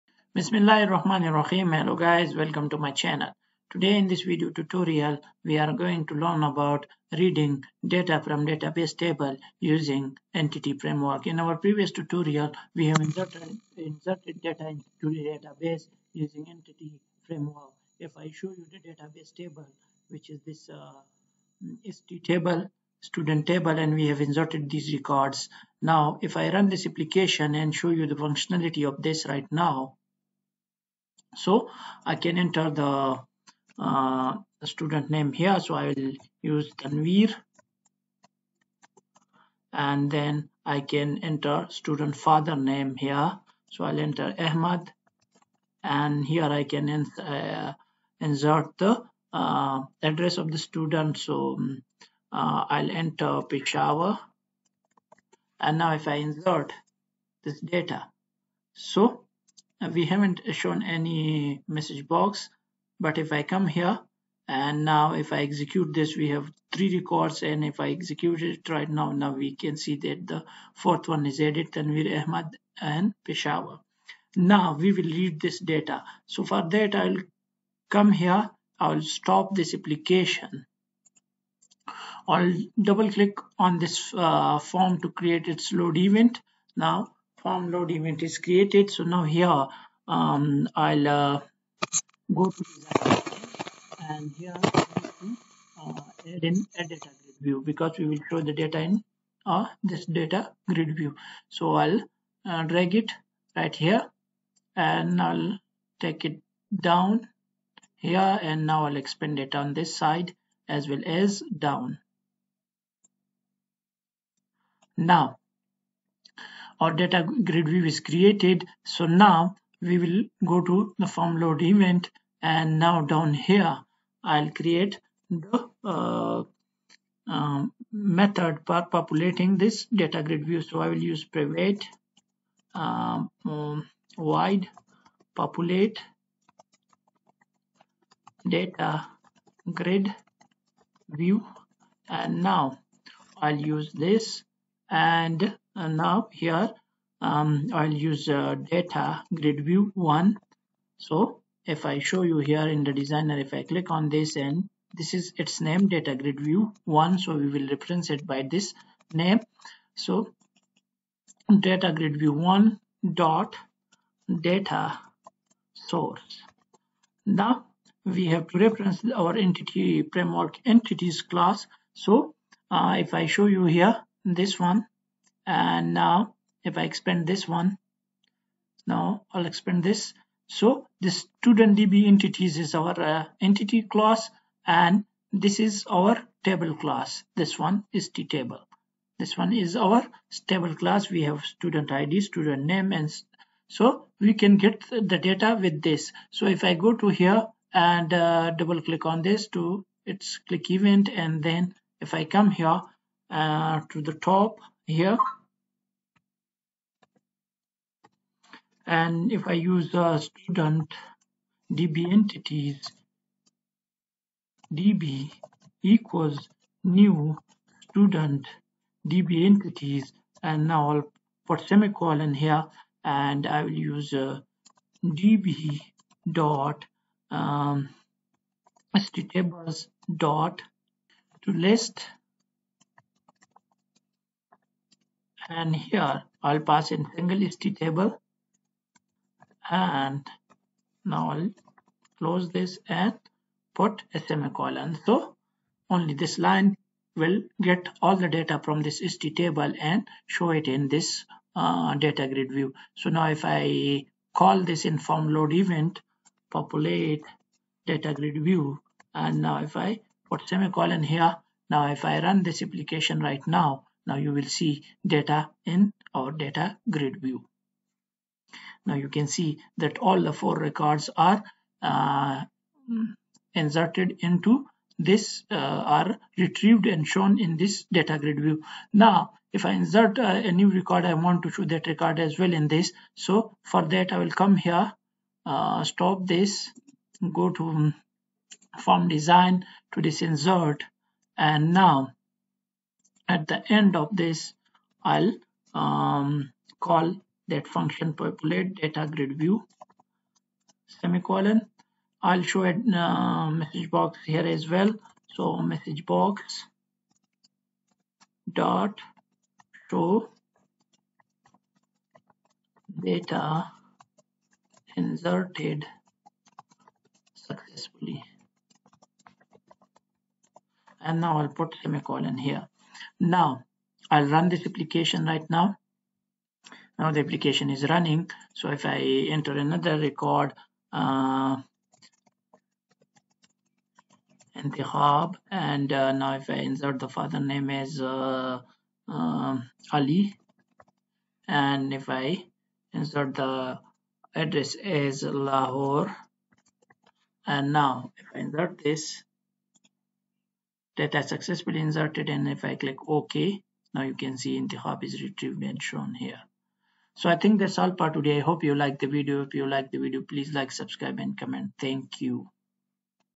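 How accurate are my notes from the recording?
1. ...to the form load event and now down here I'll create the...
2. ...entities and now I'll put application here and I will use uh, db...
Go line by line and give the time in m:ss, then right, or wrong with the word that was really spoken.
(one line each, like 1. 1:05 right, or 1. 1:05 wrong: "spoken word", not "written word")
1. 2:00 right
2. 3:39 wrong: "semicolon", not "application".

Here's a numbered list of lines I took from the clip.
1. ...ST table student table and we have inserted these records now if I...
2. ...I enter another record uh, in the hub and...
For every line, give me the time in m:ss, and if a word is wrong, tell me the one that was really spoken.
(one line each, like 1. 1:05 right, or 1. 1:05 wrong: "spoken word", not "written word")
1. 0:21 right
2. 5:28 right.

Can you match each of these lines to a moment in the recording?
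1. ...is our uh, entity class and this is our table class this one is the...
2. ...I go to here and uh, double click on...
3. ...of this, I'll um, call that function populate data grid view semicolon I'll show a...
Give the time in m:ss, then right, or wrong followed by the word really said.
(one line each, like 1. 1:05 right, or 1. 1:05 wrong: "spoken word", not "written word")
1. 3:02 right
2. 3:16 right
3. 4:53 right.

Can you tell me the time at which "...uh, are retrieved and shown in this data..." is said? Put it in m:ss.
4:35.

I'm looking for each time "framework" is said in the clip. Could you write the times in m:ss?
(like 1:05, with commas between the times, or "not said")
0:10, 0:17, 2:50.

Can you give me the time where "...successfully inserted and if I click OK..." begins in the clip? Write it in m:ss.
5:51.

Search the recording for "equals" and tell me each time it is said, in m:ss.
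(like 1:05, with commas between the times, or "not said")
3:35.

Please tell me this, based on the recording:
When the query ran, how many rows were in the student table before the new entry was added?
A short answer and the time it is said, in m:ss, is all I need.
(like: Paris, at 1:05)
3, at 1:06.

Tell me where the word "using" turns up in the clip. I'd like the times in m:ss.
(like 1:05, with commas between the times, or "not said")
0:09, 0:16.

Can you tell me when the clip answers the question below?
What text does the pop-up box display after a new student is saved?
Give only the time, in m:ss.
5:13.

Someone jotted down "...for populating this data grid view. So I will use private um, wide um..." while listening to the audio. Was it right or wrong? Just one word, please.
right.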